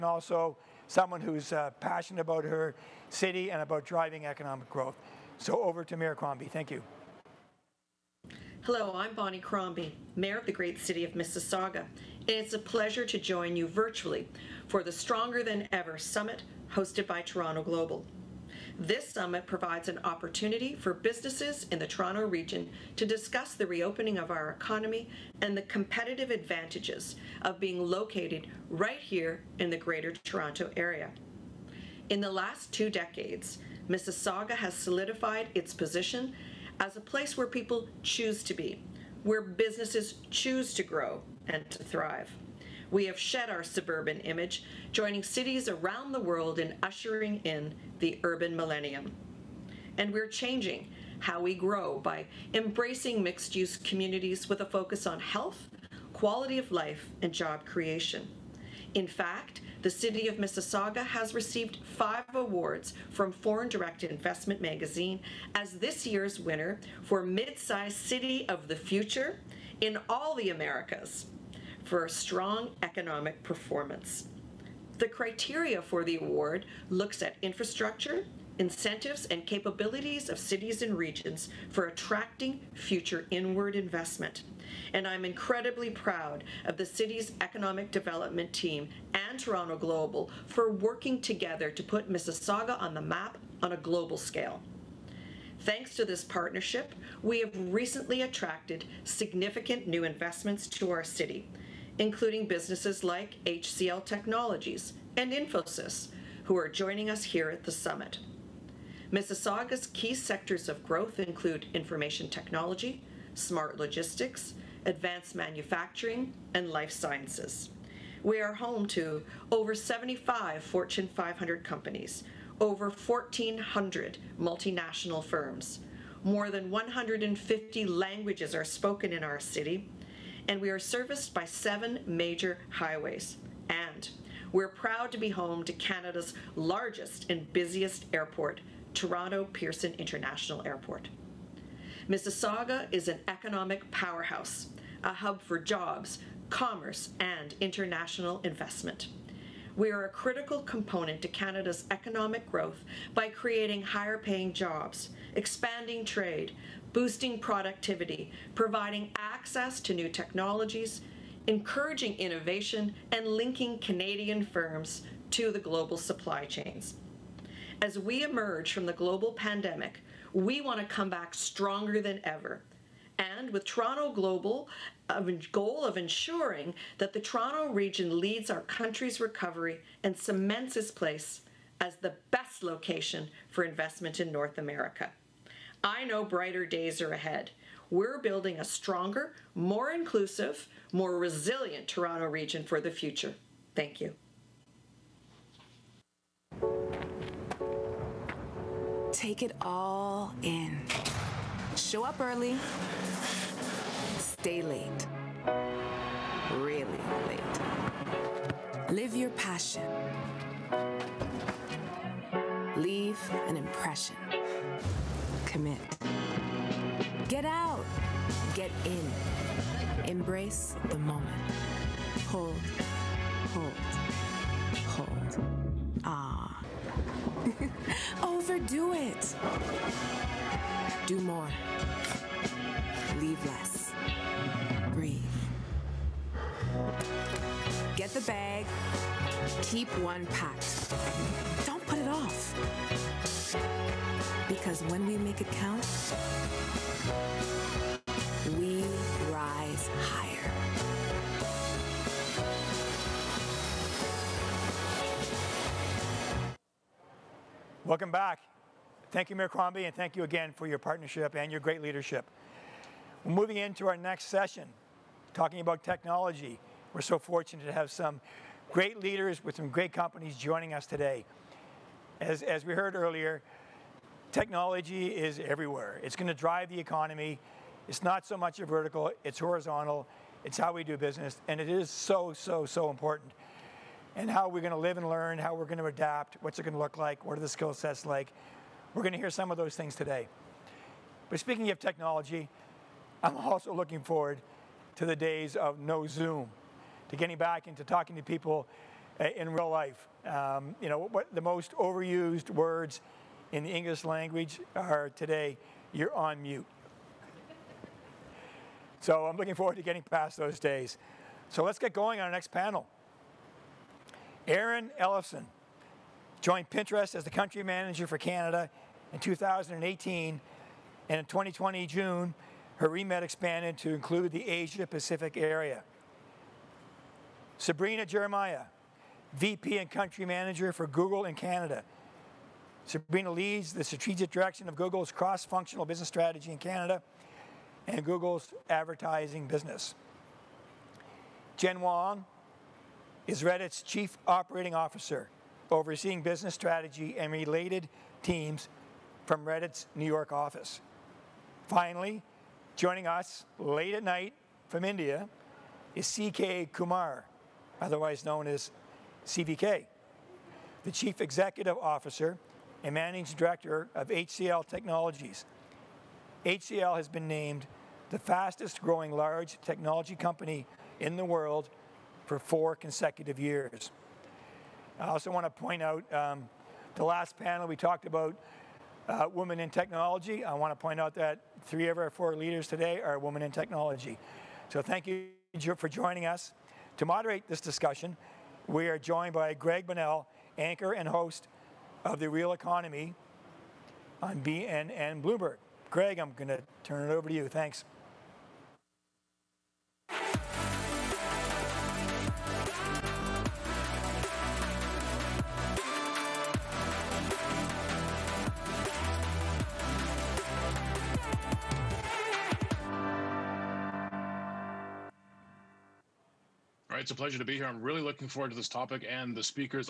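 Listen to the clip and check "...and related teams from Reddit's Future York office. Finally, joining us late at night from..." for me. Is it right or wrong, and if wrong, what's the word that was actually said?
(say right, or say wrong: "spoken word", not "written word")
wrong: "New", not "Future".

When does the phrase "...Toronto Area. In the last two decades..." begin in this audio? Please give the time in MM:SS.
00:30.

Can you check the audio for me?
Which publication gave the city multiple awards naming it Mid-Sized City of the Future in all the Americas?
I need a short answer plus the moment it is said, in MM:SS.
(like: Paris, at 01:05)
Foreign Direct Investment magazine, at 01:03.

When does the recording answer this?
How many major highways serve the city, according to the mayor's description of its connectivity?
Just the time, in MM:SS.
02:11.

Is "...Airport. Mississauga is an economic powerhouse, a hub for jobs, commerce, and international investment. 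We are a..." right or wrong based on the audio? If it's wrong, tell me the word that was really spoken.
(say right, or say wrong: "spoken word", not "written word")
right.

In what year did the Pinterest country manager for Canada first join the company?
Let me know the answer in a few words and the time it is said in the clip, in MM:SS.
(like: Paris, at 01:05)
2018, at 05:19.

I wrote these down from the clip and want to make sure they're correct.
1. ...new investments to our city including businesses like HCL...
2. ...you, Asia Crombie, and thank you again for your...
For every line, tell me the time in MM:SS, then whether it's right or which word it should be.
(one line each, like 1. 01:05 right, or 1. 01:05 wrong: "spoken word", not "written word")
1. 01:39 right
2. 04:19 wrong: "Mayor", not "Asia".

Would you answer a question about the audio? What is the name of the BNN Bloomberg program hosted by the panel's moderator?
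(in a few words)
The Real Economy.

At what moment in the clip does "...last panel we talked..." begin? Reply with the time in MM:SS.
06:17.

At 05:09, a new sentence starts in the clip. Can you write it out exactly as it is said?
so I'm looking forward to getting past those days.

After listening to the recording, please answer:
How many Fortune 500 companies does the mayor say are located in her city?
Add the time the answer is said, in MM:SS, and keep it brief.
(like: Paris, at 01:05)
over 75, at 01:59.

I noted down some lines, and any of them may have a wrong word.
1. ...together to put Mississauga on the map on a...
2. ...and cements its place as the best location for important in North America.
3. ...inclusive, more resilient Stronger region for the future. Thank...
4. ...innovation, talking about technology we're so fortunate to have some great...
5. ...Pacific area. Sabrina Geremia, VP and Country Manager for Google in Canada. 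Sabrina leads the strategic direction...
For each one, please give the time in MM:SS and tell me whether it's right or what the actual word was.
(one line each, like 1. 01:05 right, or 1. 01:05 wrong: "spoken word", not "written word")
1. 01:31 right
2. 03:00 wrong: "investment", not "important"
3. 03:09 wrong: "Toronto", not "Stronger"
4. 04:24 wrong: "session", not "innovation"
5. 05:24 right.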